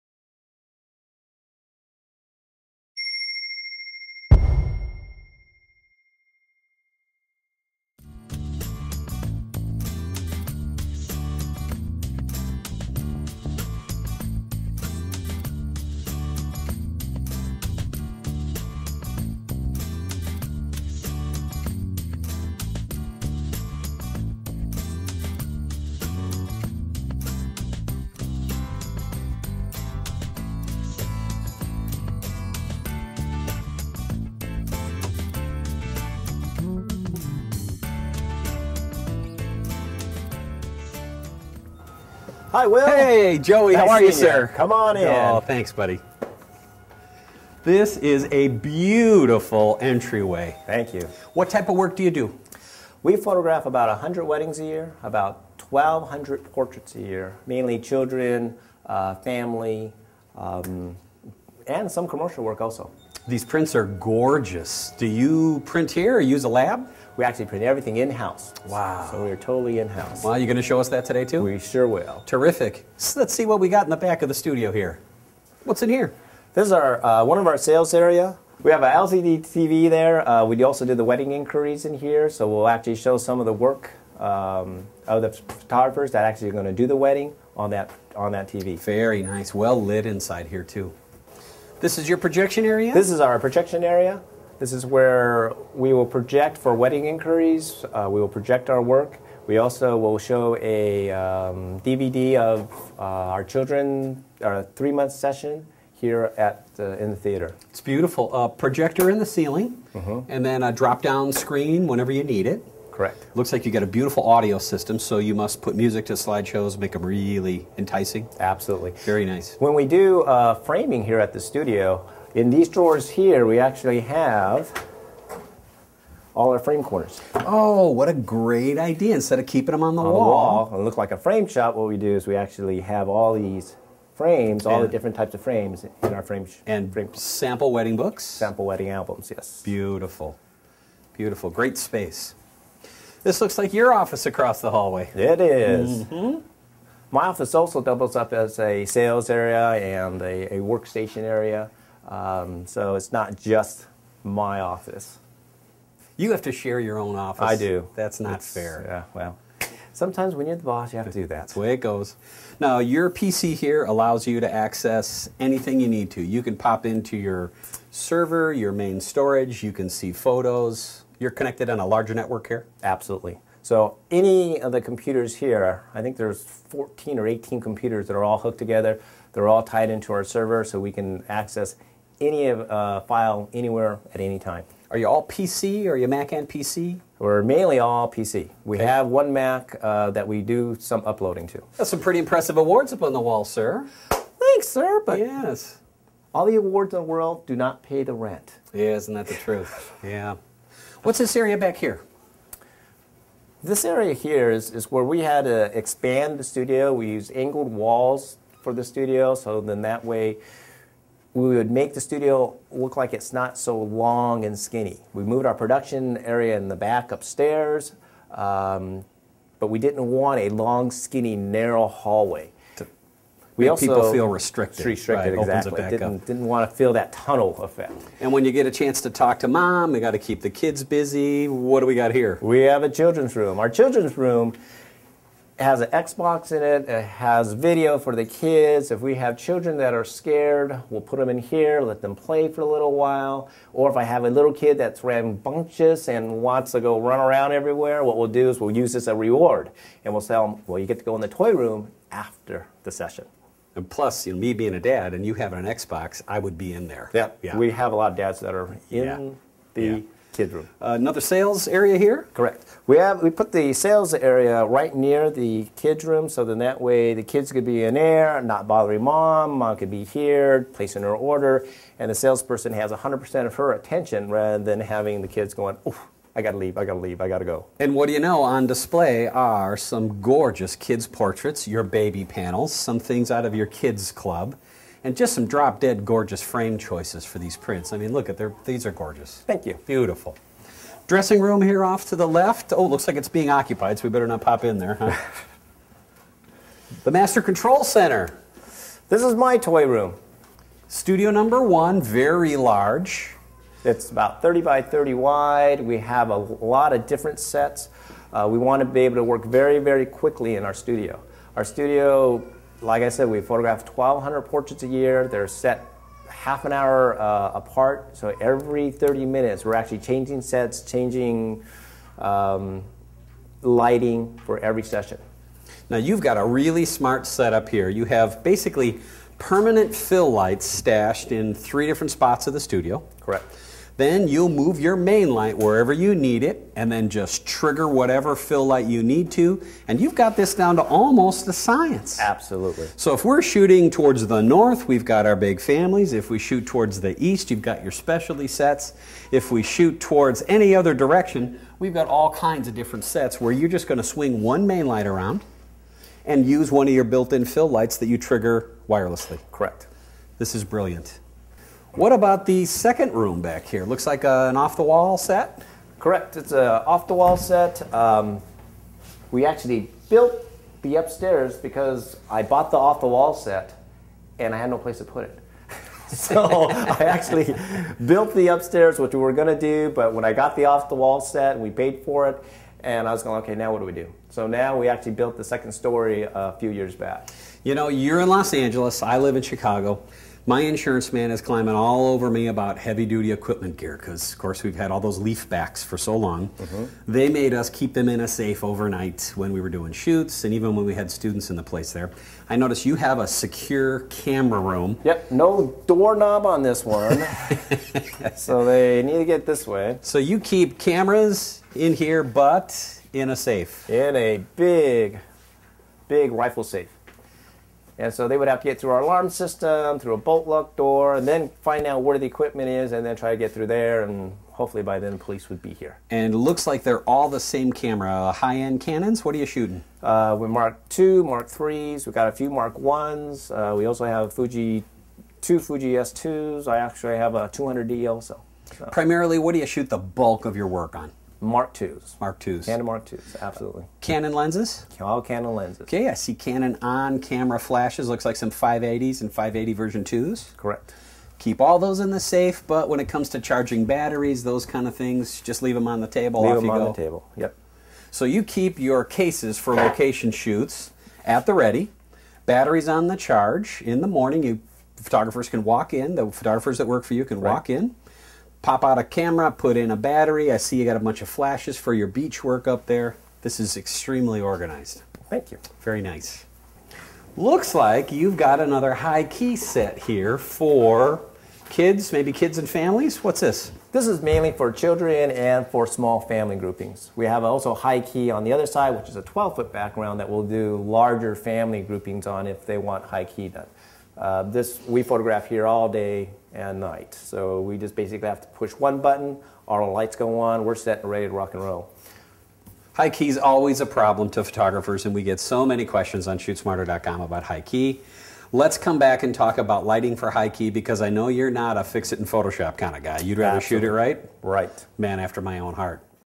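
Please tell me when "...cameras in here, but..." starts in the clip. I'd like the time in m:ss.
6:50.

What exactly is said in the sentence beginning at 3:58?
If we have children that are scared, we'll put them in here, let them play for a little while.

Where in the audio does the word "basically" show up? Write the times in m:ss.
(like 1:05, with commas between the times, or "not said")
5:28, 8:17.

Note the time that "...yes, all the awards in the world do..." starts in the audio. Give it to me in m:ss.
3:15.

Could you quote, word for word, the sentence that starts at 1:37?
Uh, we will project our work.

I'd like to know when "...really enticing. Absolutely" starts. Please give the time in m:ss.
1:57.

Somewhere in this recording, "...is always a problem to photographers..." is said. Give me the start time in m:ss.
8:23.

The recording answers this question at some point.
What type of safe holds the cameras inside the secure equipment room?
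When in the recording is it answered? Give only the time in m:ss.
6:56.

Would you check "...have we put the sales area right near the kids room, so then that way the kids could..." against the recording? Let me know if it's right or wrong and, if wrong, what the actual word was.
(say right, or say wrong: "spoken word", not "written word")
right.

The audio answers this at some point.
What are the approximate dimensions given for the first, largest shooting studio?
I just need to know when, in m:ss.
5:04.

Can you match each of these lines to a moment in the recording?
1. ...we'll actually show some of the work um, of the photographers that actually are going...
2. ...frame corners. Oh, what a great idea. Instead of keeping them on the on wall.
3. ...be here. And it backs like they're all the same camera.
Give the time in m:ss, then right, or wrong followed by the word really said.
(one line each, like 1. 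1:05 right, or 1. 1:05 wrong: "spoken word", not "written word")
1. 1:22 right
2. 2:06 right
3. 7:05 wrong: "looks", not "backs".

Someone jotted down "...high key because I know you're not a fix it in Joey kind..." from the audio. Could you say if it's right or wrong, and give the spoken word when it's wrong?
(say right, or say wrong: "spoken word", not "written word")
wrong: "Photoshop", not "Joey".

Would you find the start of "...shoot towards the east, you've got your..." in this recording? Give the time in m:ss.
5:46.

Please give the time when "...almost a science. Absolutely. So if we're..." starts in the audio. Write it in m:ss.
5:40.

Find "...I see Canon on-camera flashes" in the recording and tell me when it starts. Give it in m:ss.
7:26.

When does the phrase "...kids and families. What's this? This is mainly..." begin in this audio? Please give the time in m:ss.
8:02.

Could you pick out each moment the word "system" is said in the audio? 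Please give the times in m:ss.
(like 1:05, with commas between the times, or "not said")
1:54, 6:59.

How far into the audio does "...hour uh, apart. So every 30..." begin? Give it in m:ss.
5:16.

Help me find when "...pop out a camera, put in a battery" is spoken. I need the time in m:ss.
7:48.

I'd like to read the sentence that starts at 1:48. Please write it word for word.
A projector in the ceiling, mm -hmm.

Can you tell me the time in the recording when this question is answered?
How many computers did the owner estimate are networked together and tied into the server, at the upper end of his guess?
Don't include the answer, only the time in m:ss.
2:57.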